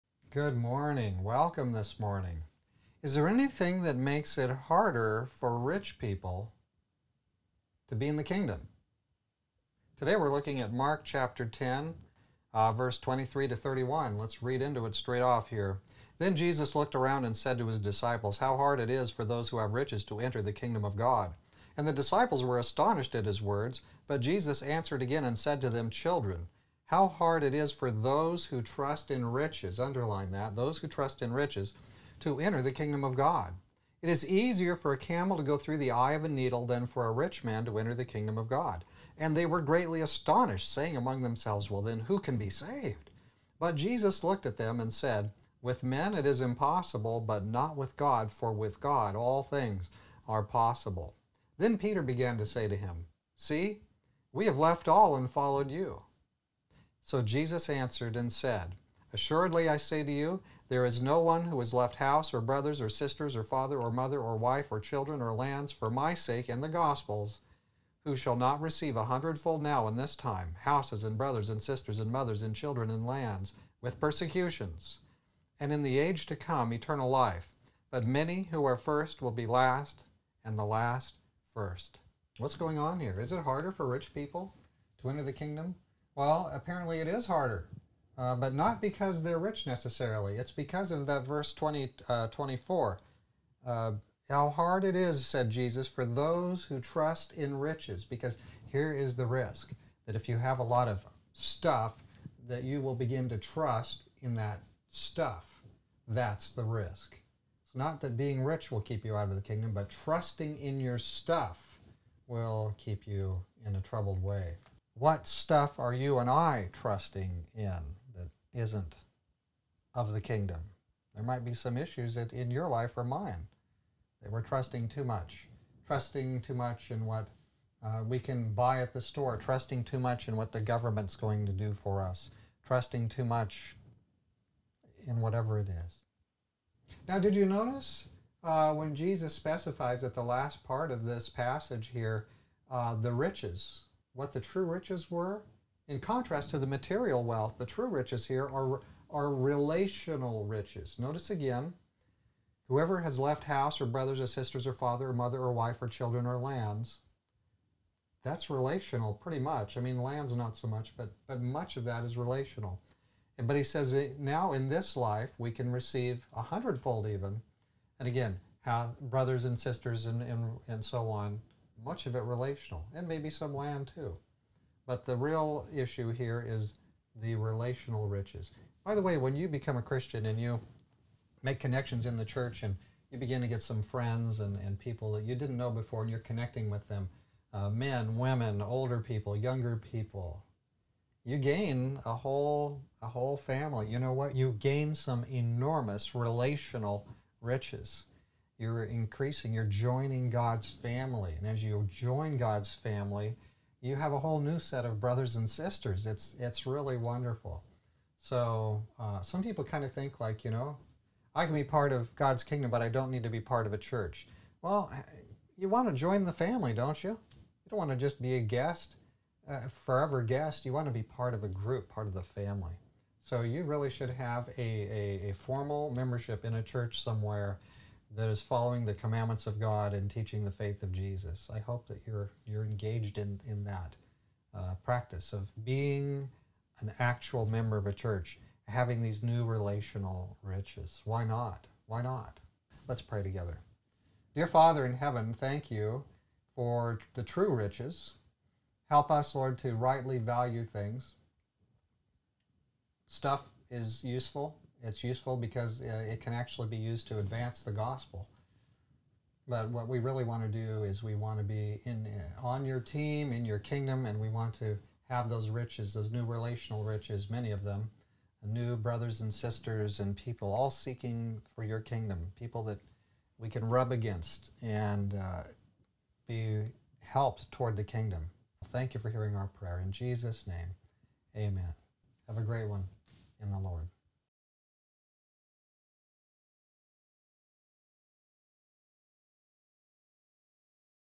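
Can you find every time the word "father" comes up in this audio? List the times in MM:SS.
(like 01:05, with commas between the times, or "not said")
01:03, 02:34, 04:04.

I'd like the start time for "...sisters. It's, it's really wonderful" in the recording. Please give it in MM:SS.
03:25.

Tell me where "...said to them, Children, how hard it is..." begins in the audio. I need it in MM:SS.
00:25.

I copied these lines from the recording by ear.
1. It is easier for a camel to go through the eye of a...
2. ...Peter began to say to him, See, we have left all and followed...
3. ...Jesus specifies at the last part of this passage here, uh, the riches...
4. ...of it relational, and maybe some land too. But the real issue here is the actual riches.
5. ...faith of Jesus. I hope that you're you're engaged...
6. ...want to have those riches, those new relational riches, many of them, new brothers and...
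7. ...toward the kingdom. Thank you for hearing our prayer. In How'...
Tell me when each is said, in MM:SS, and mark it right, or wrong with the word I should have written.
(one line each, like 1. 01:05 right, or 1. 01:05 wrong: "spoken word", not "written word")
1. 00:34 right
2. 00:51 right
3. 02:18 right
4. 02:52 wrong: "relational", not "actual"
5. 03:50 right
6. 04:24 right
7. 04:37 wrong: "Jesus", not "How".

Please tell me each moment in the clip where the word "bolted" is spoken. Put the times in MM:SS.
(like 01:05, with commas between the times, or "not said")
not said.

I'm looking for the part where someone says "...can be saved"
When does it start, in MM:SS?
00:42.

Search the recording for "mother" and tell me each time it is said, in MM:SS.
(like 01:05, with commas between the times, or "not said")
01:03, 01:12, 02:35.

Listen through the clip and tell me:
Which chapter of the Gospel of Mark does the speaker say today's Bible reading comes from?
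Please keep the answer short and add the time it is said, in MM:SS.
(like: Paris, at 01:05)
10, at 00:10.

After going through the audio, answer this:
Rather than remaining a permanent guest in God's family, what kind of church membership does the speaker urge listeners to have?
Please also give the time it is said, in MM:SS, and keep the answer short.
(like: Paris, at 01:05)
Formal membership, at 03:45.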